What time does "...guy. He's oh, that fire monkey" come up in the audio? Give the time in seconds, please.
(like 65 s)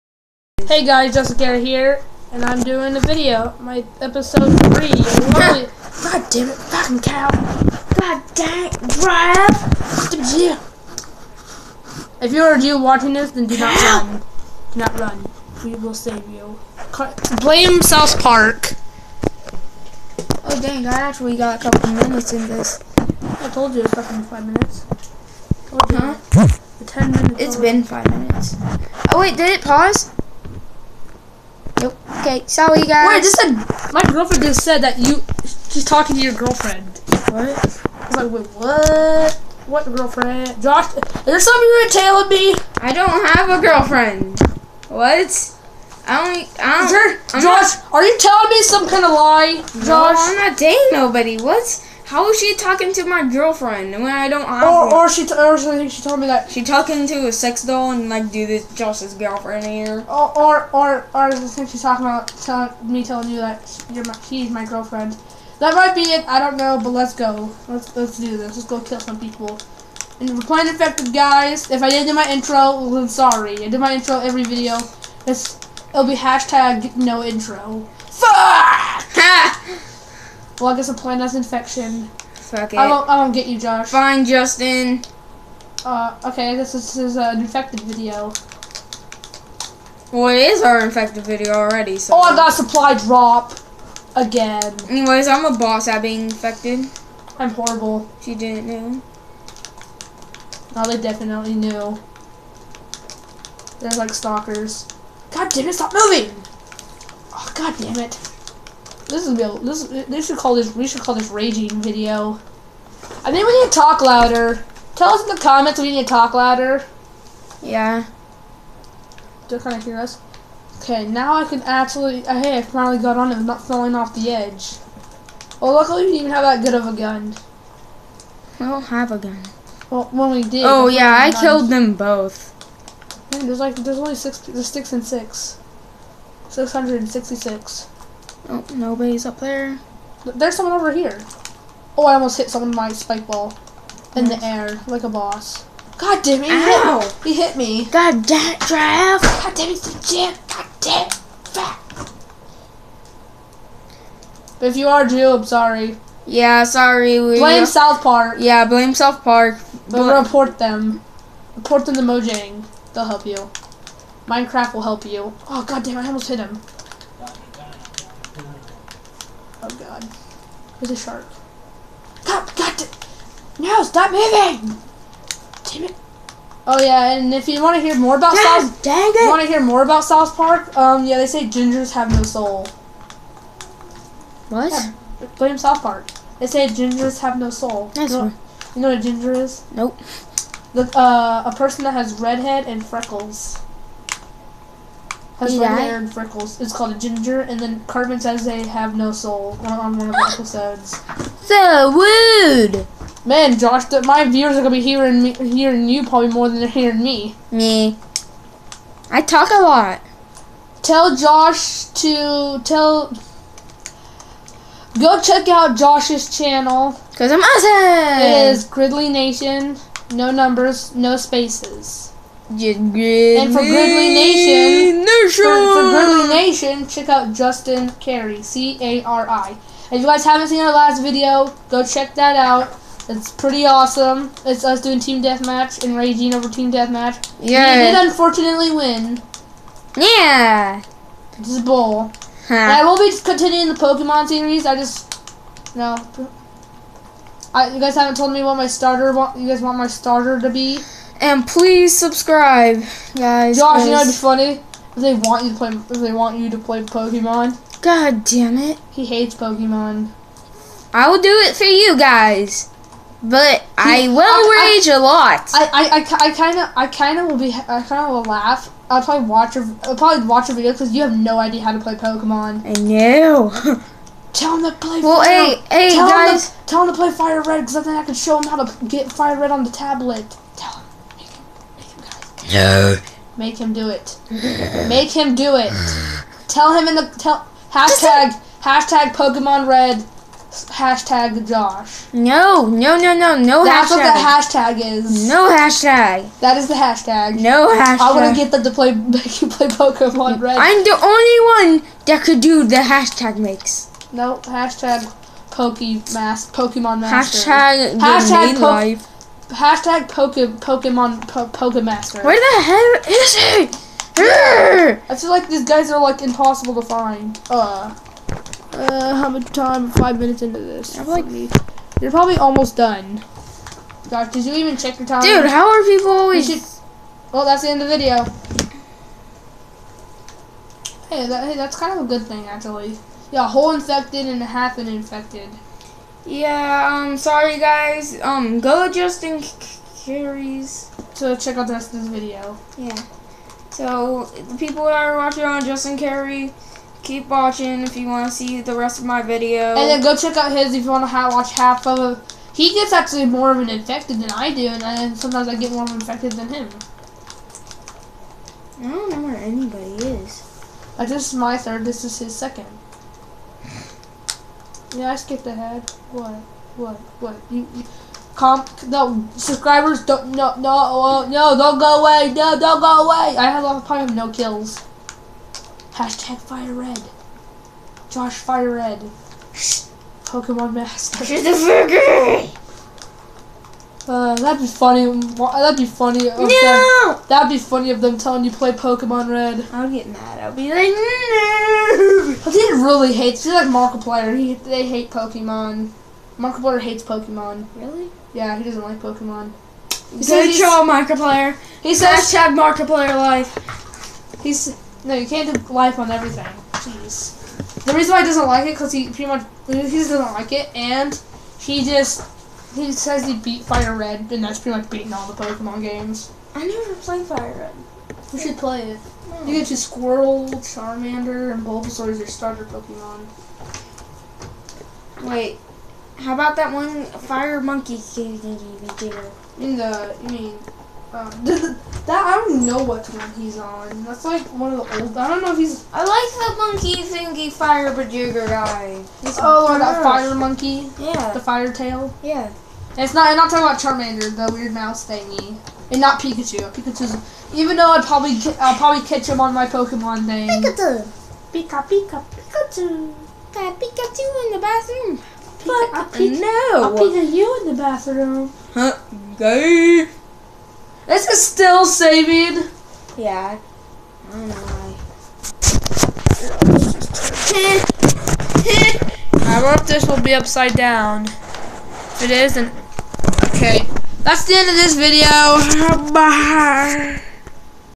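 438 s.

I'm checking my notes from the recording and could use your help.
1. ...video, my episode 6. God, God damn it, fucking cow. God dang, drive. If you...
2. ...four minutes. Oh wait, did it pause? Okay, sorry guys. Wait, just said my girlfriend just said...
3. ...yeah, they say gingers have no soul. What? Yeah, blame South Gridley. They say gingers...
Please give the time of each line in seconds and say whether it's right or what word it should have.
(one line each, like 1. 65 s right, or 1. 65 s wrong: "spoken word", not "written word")
1. 3 s wrong: "3", not "6"
2. 27 s wrong: "five", not "four"
3. 181 s wrong: "Park", not "Gridley".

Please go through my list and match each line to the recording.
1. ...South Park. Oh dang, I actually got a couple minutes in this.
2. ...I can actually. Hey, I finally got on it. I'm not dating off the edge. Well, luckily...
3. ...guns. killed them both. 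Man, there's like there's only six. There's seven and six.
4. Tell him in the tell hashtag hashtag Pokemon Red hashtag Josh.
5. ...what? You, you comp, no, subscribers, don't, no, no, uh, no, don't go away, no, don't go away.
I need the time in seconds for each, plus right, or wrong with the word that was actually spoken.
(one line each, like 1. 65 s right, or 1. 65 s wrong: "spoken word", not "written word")
1. 17 s right
2. 121 s wrong: "falling", not "dating"
3. 131 s wrong: "six", not "seven"
4. 286 s right
5. 367 s right.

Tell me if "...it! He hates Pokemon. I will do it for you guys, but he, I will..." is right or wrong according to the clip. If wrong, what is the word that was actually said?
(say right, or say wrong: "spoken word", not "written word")
right.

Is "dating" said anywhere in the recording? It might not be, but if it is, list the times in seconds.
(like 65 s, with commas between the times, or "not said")
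50 s.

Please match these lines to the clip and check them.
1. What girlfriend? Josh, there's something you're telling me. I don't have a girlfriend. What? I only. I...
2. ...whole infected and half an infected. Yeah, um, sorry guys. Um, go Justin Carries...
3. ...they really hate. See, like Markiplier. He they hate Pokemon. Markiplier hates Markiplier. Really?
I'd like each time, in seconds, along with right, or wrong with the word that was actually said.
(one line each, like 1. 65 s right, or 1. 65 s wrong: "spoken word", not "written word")
1. 39 s right
2. 333 s right
3. 392 s wrong: "Pokemon", not "Markiplier".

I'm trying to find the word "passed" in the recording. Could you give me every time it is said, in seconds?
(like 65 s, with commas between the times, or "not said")
not said.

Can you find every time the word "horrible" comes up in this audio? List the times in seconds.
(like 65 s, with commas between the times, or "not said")
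97 s.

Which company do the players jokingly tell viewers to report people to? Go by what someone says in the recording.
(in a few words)
Mojang.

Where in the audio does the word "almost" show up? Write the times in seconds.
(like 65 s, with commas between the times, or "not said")
142 s, 166 s, 322 s.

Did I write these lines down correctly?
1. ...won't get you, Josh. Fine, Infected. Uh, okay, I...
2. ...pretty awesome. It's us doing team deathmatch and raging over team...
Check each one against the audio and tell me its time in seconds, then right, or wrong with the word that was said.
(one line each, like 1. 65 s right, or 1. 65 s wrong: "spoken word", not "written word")
1. 83 s wrong: "Justin", not "Infected"
2. 233 s right.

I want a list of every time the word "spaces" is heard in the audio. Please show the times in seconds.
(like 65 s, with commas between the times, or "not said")
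221 s.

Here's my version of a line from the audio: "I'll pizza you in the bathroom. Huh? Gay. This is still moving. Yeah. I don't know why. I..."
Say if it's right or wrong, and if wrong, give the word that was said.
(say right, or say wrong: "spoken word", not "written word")
wrong: "saving", not "moving".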